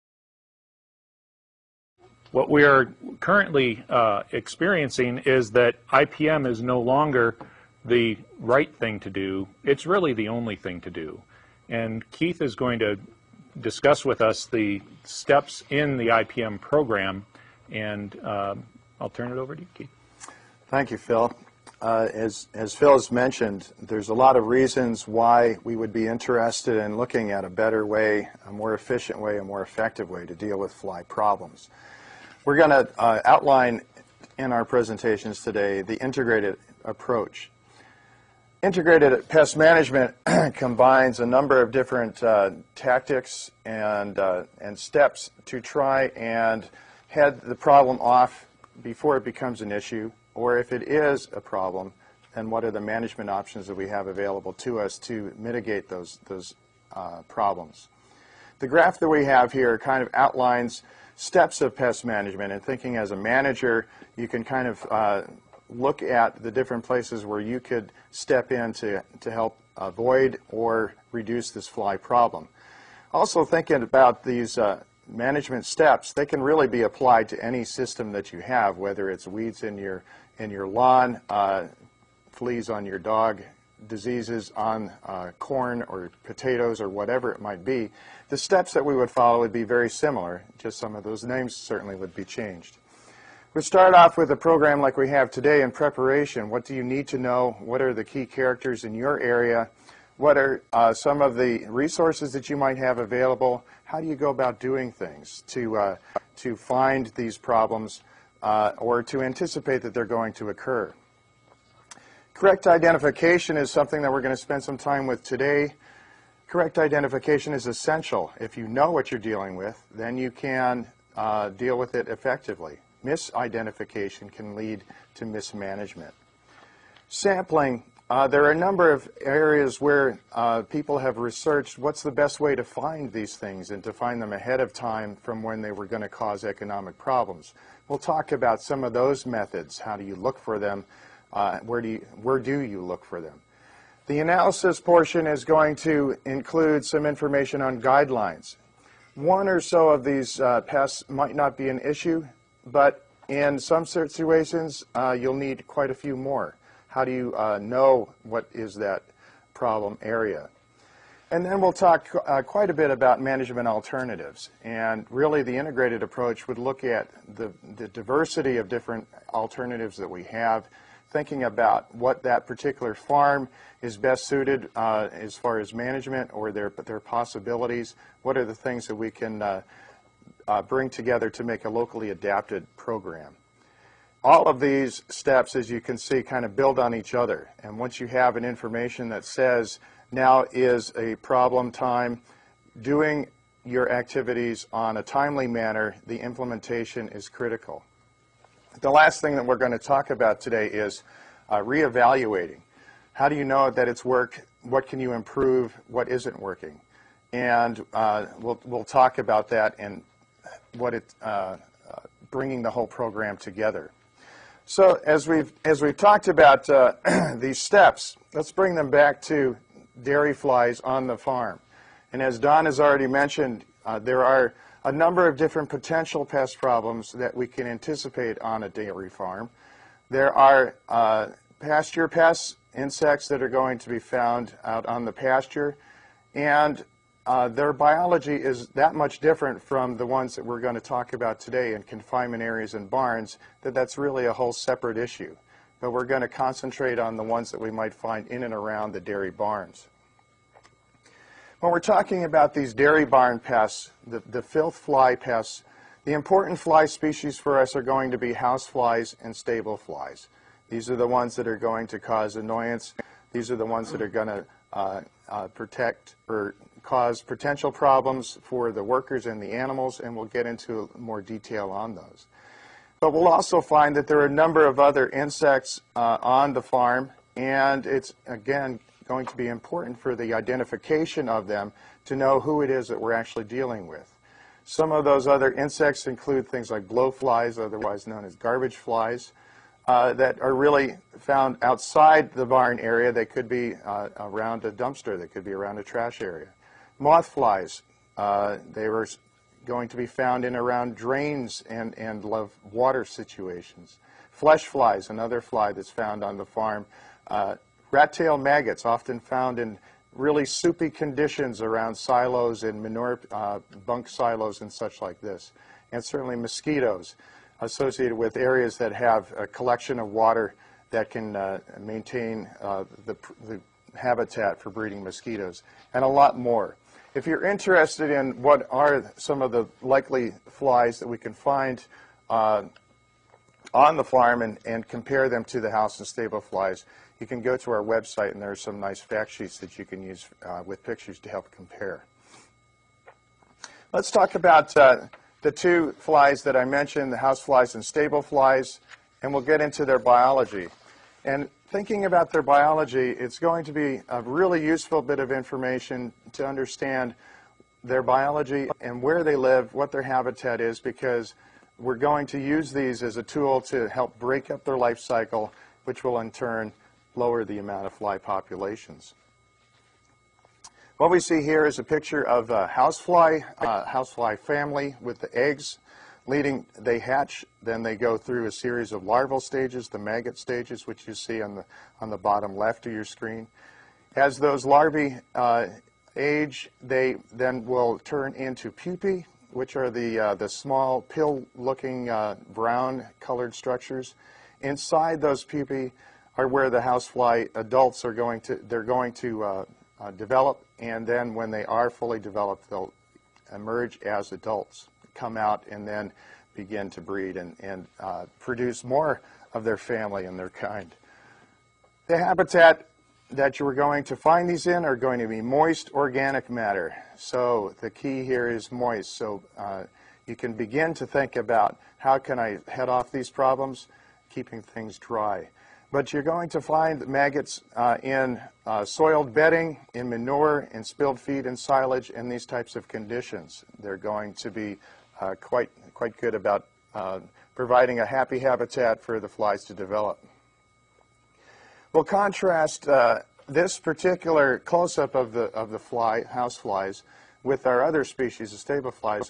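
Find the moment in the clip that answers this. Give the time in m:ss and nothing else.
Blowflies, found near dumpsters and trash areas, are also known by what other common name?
4:48.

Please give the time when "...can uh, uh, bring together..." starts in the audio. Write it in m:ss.
2:59.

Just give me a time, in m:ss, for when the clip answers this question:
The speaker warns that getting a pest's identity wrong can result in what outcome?
2:05.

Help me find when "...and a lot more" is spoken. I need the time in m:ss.
5:25.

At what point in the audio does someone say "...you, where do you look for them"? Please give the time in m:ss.
2:21.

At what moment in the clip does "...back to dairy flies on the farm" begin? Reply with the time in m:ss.
3:38.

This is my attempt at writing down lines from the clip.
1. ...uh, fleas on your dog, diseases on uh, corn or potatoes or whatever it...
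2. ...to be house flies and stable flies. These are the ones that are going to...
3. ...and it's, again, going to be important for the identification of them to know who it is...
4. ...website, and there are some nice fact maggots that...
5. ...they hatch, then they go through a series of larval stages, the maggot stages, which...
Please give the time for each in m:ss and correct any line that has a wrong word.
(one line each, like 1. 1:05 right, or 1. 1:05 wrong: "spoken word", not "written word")
1. 1:21 right
2. 4:18 right
3. 4:37 right
4. 5:37 wrong: "sheets", not "maggots"
5. 6:16 right.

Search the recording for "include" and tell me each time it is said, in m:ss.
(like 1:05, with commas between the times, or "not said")
2:26, 4:46.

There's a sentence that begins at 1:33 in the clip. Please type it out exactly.
We start off with a program like we have today in preparation.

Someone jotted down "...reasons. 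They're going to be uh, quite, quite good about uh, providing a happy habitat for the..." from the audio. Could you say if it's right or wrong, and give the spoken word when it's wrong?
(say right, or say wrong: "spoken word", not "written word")
wrong: "conditions", not "reasons".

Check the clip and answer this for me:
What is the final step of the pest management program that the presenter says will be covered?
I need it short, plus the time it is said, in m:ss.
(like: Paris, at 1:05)
reevaluating, at 3:21.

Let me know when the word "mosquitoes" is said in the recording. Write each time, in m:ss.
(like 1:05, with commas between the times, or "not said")
5:16, 5:25.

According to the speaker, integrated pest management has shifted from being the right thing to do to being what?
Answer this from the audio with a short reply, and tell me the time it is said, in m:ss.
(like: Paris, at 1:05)
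the only thing to do, at 0:10.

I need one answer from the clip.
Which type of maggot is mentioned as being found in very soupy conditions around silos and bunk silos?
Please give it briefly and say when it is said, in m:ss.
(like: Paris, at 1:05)
Rat tail maggots, at 5:07.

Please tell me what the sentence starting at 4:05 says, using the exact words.
But we're going to concentrate on the ones that we might find in and around the dairy barns.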